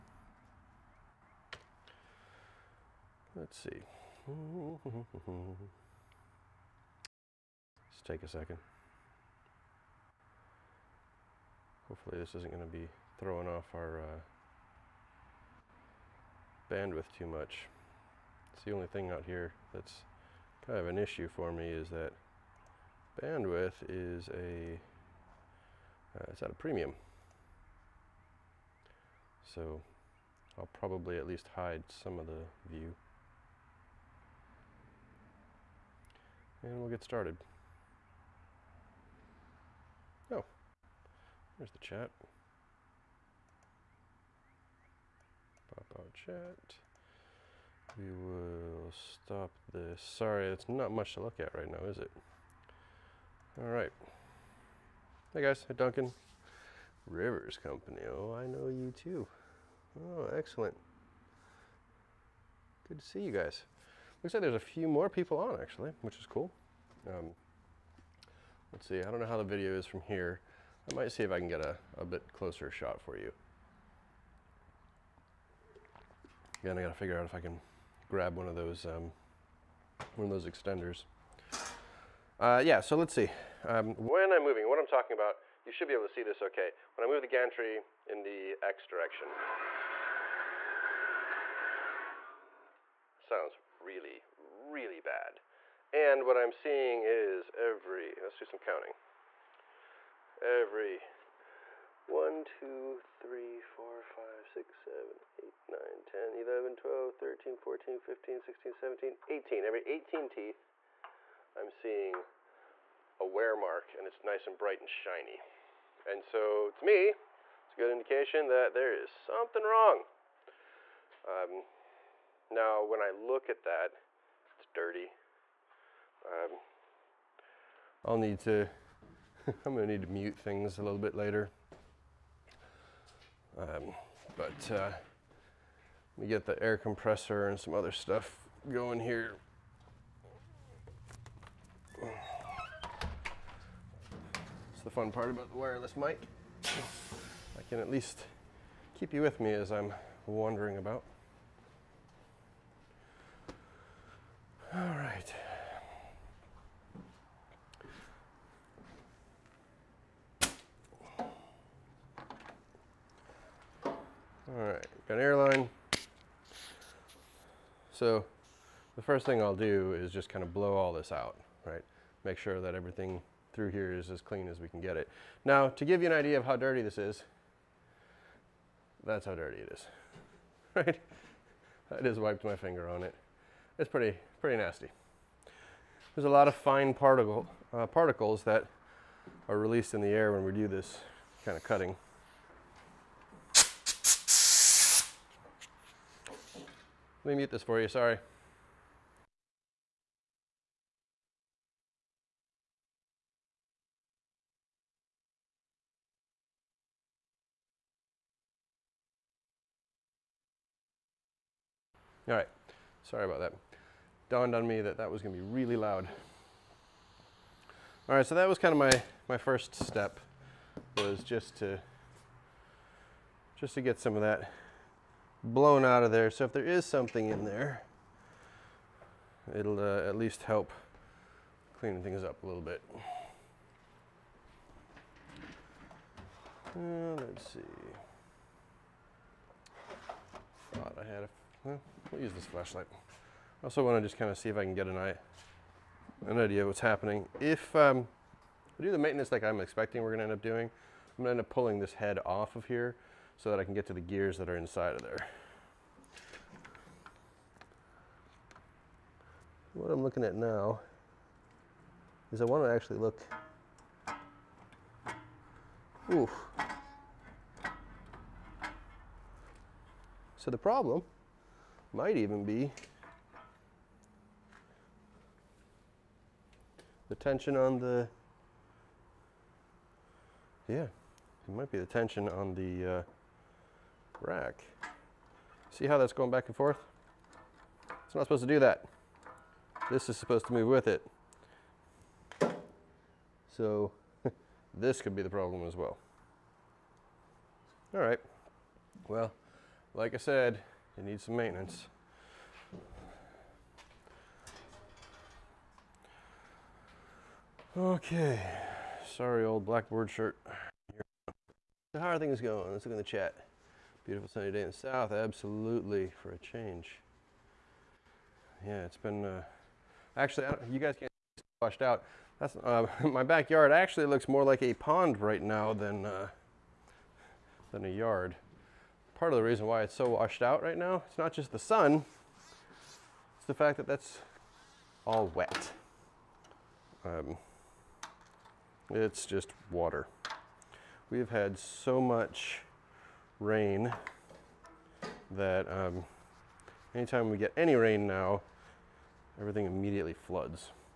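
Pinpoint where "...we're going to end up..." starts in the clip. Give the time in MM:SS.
04:10.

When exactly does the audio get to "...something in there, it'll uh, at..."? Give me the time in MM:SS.
03:46.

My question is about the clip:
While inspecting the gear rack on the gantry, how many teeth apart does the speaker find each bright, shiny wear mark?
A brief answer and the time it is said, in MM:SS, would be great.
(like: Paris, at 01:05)
18, at 01:49.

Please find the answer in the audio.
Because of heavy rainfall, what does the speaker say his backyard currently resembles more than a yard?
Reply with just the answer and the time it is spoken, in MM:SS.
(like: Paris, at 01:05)
a pond, at 05:24.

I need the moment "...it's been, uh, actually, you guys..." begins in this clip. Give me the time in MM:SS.
05:18.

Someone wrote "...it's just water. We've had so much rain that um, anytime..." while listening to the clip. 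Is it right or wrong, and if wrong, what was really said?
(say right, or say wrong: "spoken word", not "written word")
right.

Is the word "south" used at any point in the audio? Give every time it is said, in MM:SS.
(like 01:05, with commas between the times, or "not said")
05:14.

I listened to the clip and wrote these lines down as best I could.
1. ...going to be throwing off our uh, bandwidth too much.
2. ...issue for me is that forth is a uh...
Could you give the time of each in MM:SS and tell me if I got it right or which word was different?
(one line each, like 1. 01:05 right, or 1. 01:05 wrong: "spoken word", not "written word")
1. 00:12 right
2. 00:20 wrong: "bandwidth", not "forth".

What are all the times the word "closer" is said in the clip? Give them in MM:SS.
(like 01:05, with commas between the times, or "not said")
01:12.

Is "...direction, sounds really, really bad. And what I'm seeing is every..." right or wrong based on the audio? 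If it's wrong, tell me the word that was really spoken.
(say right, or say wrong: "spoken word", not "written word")
right.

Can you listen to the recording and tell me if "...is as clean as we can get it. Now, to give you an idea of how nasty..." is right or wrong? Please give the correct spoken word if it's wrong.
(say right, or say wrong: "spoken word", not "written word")
wrong: "dirty", not "nasty".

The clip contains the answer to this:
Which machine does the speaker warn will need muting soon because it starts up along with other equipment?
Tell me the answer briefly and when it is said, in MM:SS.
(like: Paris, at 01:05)
air compressor, at 02:16.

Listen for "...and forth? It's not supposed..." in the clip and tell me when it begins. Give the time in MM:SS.
04:46.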